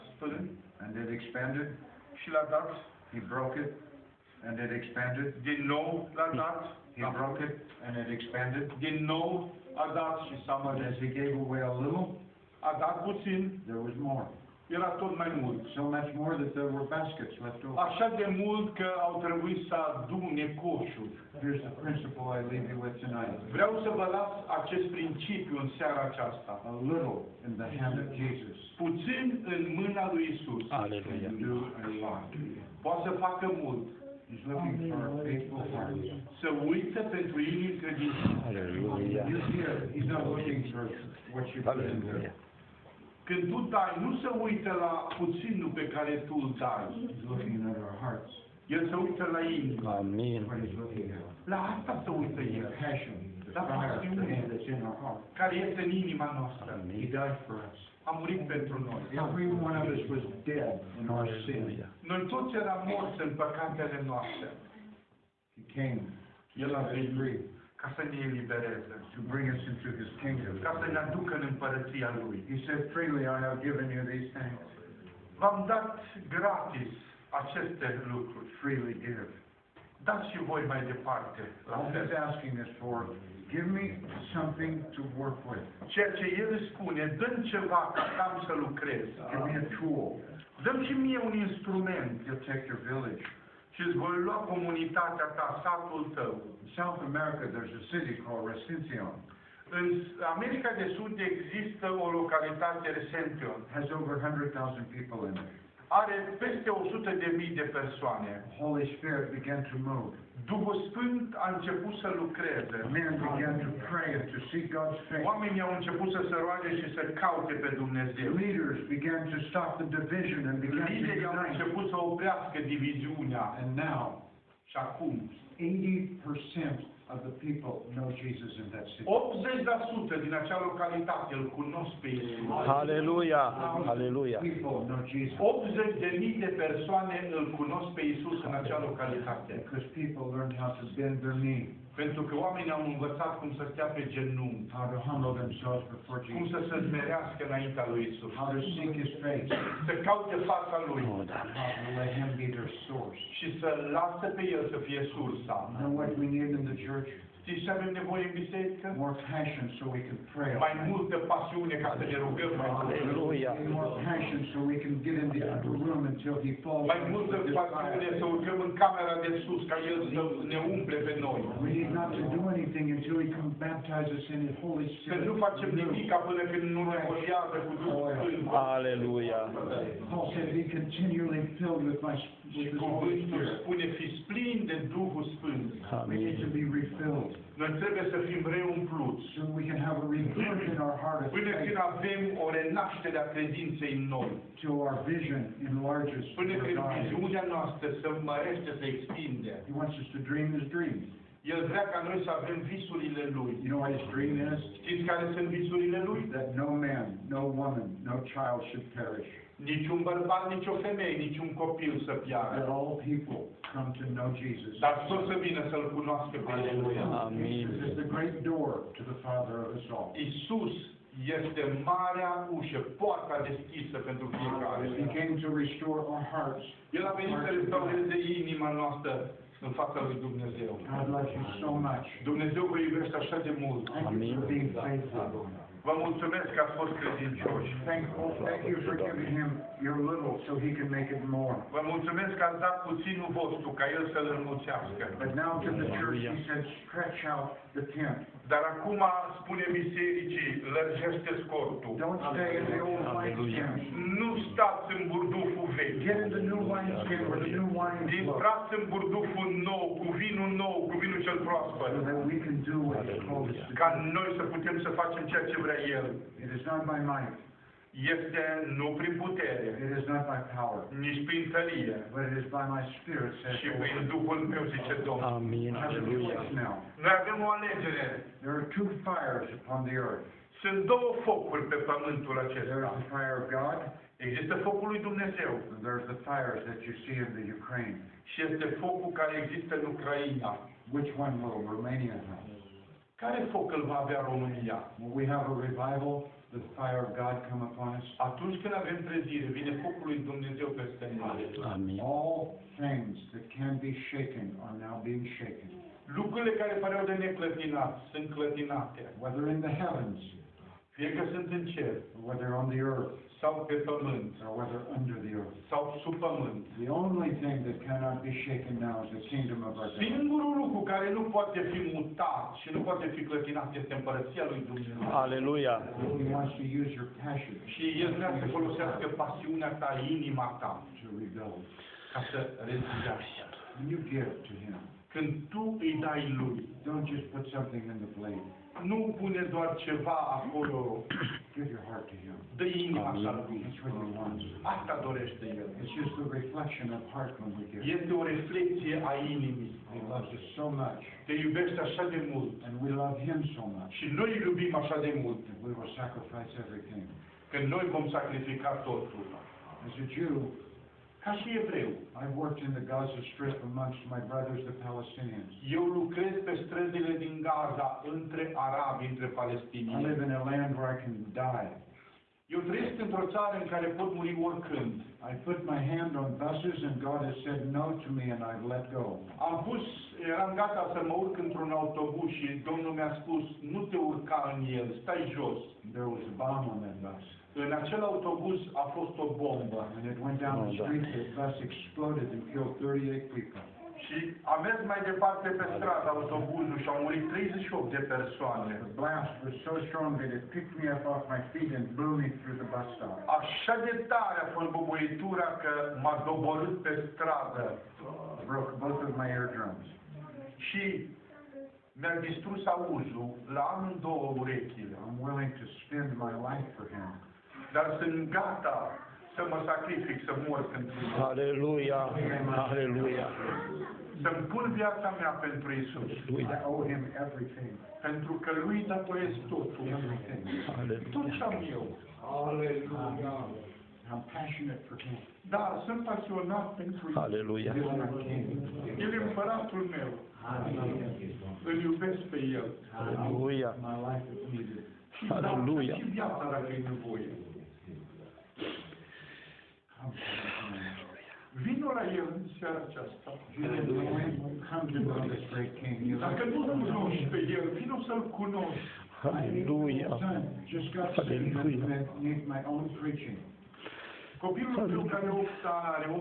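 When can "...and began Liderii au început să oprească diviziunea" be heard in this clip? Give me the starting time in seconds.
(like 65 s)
120 s.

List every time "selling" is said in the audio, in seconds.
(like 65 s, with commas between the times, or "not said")
not said.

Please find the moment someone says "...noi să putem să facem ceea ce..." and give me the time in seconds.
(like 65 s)
264 s.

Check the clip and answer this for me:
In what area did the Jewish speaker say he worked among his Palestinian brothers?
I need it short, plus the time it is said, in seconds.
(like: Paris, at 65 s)
Gaza Strip, at 362 s.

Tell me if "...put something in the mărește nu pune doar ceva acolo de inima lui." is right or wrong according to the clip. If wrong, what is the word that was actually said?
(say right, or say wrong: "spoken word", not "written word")
wrong: "plate", not "mărește".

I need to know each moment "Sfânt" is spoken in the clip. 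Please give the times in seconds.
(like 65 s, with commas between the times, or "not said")
110 s, 178 s, 185 s.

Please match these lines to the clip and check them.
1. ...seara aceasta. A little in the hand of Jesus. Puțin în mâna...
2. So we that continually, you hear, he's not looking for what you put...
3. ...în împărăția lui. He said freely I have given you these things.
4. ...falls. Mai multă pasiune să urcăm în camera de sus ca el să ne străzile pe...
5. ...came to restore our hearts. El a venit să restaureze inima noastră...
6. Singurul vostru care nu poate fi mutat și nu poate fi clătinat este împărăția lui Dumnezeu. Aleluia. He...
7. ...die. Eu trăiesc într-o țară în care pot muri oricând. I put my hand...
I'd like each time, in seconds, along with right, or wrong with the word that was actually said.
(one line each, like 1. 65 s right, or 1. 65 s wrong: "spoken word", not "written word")
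1. 25 s right
2. 36 s wrong: "typically", not "continually"
3. 71 s right
4. 166 s wrong: "umple", not "străzile"
5. 225 s right
6. 320 s wrong: "lucru", not "vostru"
7. 371 s right.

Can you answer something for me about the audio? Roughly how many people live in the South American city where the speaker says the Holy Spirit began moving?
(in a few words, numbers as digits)
100,000.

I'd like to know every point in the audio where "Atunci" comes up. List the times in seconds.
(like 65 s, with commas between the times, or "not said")
298 s.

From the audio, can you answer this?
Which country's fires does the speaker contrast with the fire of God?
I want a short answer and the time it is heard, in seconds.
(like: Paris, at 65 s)
Ukraine, at 287 s.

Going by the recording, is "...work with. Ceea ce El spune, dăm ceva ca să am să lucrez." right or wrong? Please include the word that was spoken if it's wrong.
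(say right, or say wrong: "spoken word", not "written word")
right.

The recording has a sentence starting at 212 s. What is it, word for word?
That all people come to know Jesus.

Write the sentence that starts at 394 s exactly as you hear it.
Și a mers mai departe pe stradă autobuzul și au murit 38 de persoane.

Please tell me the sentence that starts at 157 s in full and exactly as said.
Știți ce avem nevoie în biserică?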